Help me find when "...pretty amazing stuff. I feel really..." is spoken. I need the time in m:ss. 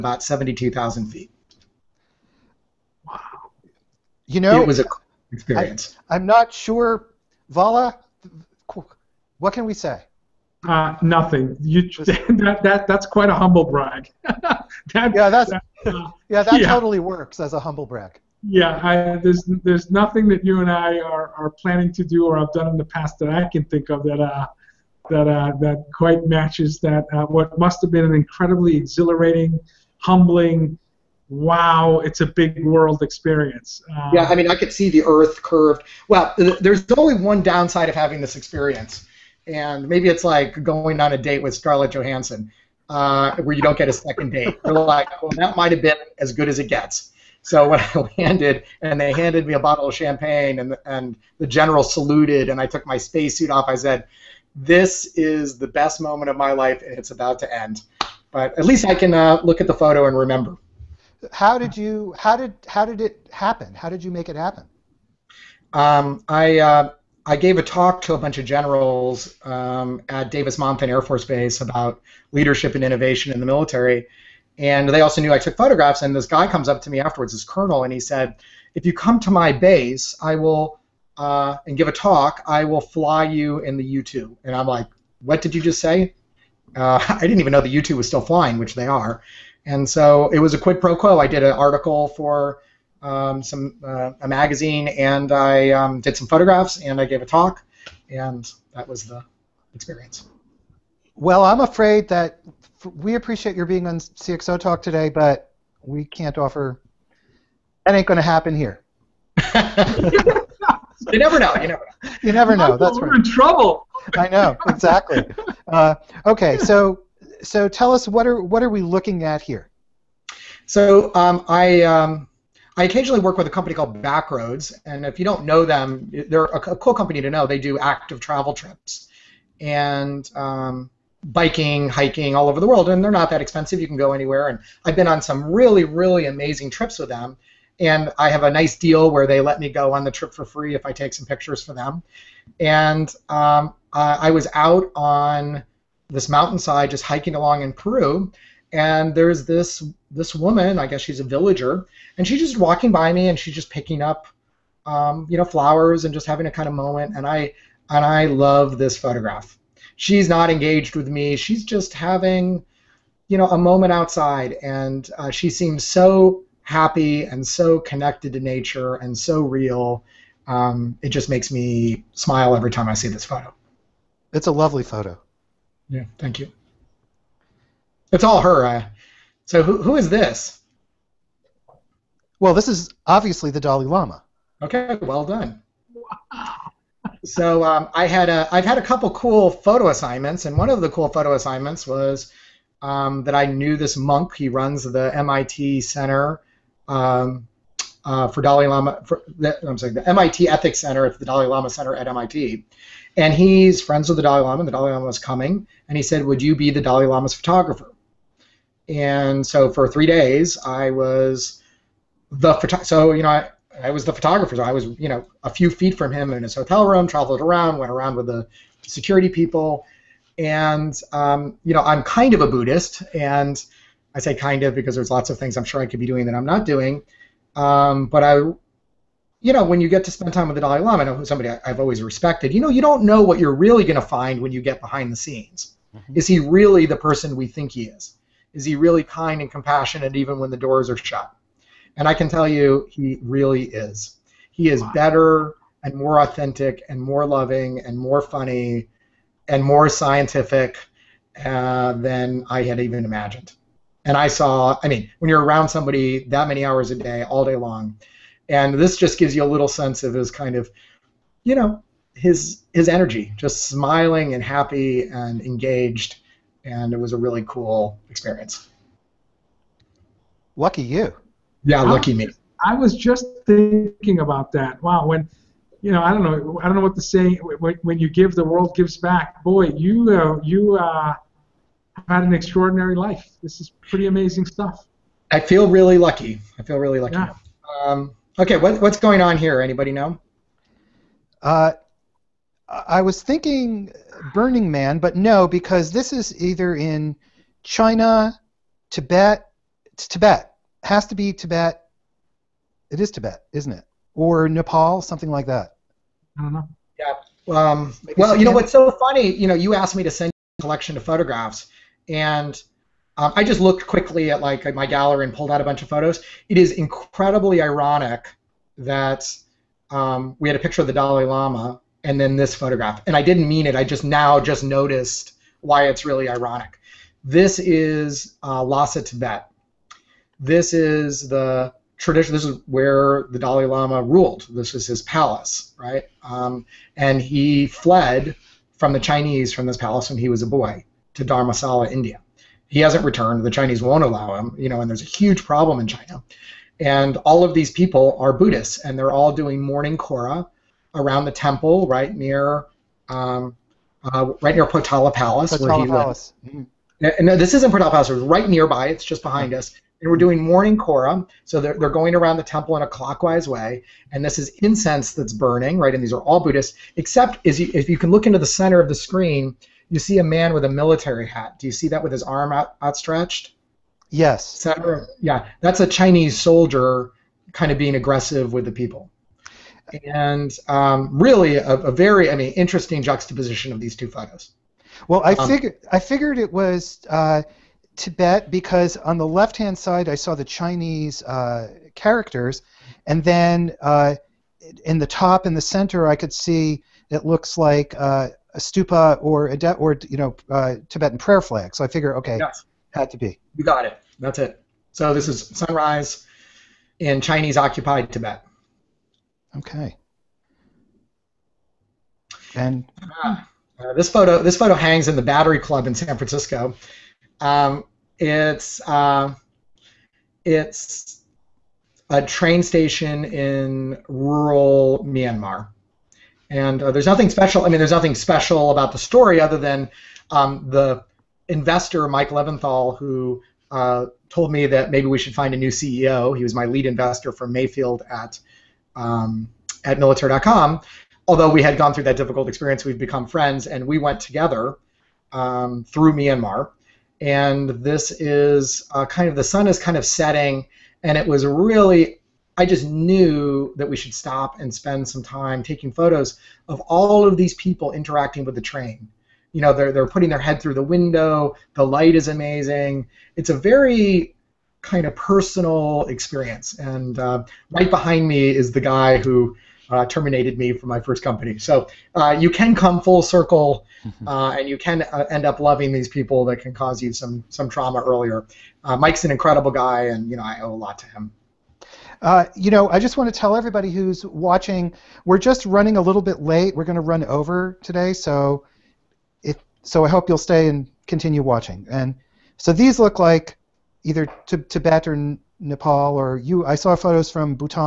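4:43.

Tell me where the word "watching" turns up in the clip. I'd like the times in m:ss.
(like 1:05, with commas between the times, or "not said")
8:04, 8:11.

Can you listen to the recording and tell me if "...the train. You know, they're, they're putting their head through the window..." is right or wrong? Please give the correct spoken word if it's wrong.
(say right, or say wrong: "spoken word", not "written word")
right.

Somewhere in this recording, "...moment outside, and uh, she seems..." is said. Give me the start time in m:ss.
2:43.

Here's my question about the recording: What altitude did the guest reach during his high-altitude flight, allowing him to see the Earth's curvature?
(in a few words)
72,000 feet.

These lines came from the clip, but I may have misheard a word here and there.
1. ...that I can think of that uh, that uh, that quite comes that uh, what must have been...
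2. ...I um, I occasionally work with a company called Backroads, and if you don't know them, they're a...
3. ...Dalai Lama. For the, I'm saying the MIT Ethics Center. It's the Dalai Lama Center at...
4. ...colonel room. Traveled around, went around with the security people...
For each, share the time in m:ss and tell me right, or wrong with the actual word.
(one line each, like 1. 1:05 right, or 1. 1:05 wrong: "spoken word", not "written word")
1. 0:23 wrong: "matches", not "comes"
2. 2:01 right
3. 3:18 right
4. 3:36 wrong: "hotel", not "colonel".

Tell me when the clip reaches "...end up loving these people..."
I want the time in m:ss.
7:55.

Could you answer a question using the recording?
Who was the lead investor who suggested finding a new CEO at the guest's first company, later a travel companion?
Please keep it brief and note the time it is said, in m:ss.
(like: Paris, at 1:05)
Mike Levinthal, at 7:12.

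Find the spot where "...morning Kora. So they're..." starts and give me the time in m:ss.
6:00.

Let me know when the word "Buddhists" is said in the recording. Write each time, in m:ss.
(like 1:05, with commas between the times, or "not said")
3:42, 5:48, 6:06.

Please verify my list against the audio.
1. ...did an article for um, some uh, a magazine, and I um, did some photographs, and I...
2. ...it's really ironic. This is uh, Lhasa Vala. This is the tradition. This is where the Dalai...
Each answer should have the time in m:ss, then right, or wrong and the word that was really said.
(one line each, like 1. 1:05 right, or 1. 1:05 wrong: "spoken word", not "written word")
1. 1:31 right
2. 5:25 wrong: "Tibet", not "Vala".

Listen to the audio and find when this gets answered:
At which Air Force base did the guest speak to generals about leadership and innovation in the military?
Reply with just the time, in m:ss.
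1:10.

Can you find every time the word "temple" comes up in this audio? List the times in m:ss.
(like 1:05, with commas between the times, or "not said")
5:51, 6:02.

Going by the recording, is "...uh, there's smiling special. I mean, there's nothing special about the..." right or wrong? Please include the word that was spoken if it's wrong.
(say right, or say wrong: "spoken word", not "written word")
wrong: "nothing", not "smiling".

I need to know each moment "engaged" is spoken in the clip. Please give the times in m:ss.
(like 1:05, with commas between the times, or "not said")
2:40, 4:25.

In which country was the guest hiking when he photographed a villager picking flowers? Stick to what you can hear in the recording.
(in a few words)
Peru.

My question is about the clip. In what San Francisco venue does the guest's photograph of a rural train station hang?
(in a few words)
Battery Club.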